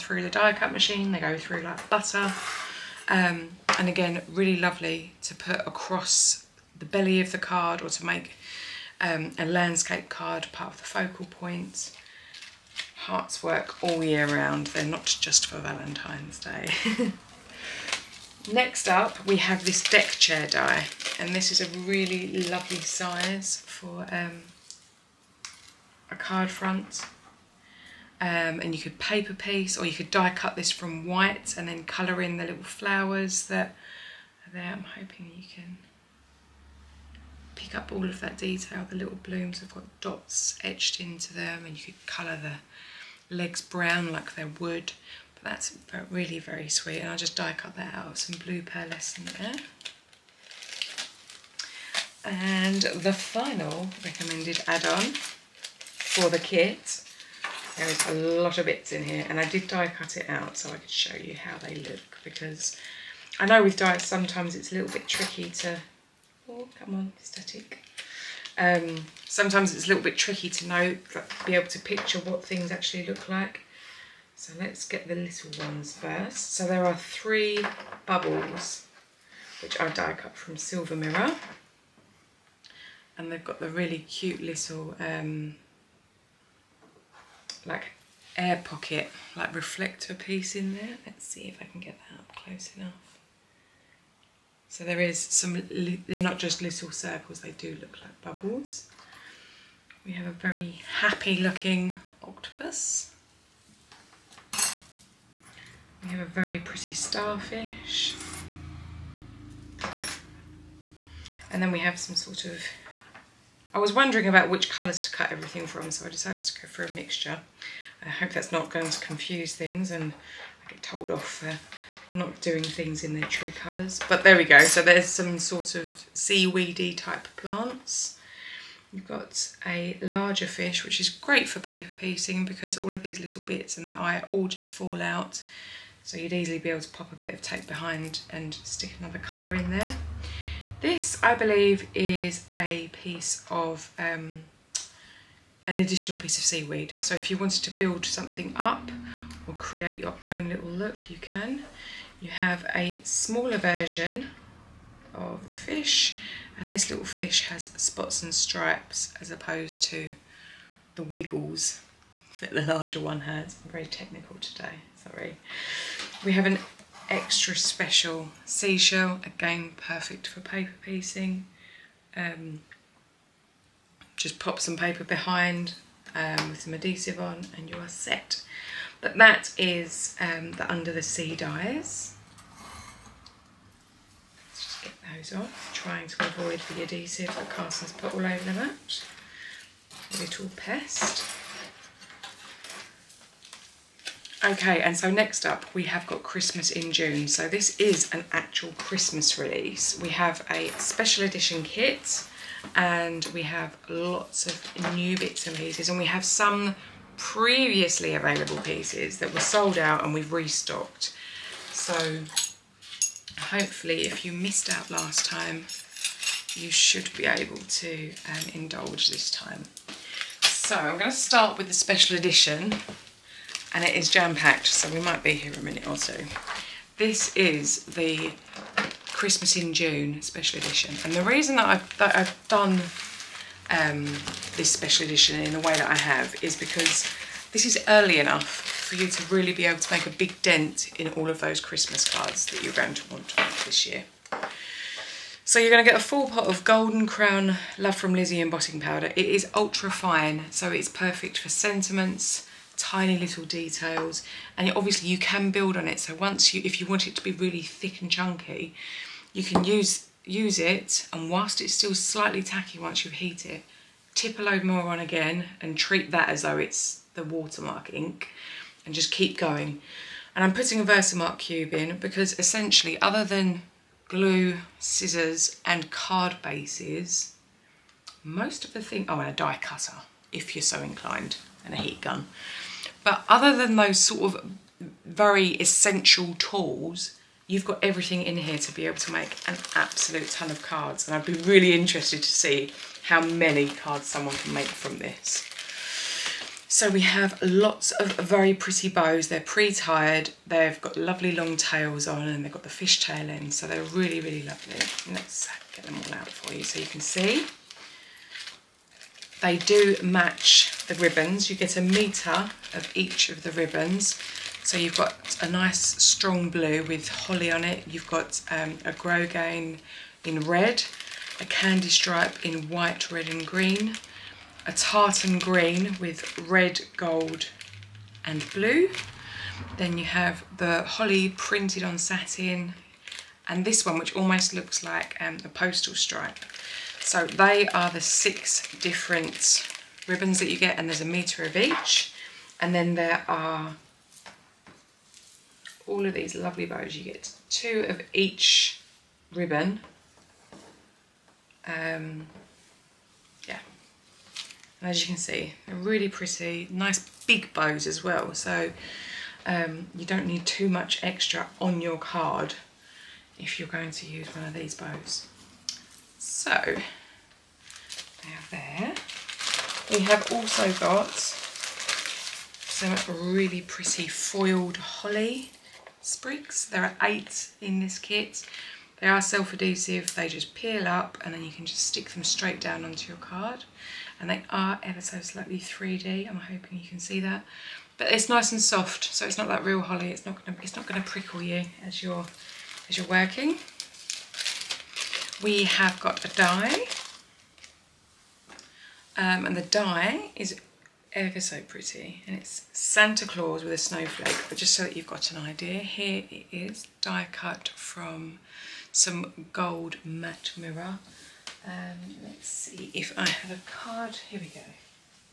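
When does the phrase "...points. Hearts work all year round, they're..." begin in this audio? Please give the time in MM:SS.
00:11.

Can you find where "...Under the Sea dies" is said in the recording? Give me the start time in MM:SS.
03:00.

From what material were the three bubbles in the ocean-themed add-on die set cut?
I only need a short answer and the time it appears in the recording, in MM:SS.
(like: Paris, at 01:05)
Silver Mirror, at 01:20.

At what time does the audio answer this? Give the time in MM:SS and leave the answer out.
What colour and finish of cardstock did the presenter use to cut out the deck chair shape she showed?
00:48.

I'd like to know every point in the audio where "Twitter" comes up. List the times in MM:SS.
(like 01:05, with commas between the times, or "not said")
not said.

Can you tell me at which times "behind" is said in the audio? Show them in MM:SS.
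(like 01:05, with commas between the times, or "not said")
02:17, 02:55.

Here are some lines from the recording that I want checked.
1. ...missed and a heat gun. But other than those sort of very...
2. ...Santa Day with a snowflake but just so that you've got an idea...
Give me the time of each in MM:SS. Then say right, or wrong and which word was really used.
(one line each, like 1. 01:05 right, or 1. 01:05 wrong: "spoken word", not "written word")
1. 04:40 wrong: "inclined", not "missed"
2. 06:42 wrong: "Claus", not "Day".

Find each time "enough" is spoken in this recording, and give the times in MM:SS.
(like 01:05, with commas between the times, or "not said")
01:32, 03:58.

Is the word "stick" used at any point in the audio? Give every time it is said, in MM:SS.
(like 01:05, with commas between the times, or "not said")
02:18, 06:21.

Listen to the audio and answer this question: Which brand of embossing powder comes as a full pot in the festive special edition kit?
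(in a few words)
Love from Lizi.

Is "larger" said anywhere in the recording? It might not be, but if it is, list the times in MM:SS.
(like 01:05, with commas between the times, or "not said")
02:10, 02:42.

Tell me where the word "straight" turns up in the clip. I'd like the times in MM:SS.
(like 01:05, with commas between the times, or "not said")
06:22.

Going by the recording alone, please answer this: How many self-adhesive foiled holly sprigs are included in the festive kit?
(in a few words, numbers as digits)
8.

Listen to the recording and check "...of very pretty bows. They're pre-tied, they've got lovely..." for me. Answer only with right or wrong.
right.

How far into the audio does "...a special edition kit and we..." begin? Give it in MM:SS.
03:20.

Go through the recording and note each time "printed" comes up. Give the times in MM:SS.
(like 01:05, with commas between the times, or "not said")
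05:31.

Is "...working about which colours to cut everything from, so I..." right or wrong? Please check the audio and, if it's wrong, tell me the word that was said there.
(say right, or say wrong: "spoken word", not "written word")
wrong: "wondering", not "working".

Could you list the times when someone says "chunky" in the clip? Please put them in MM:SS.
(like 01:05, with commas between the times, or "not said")
04:18.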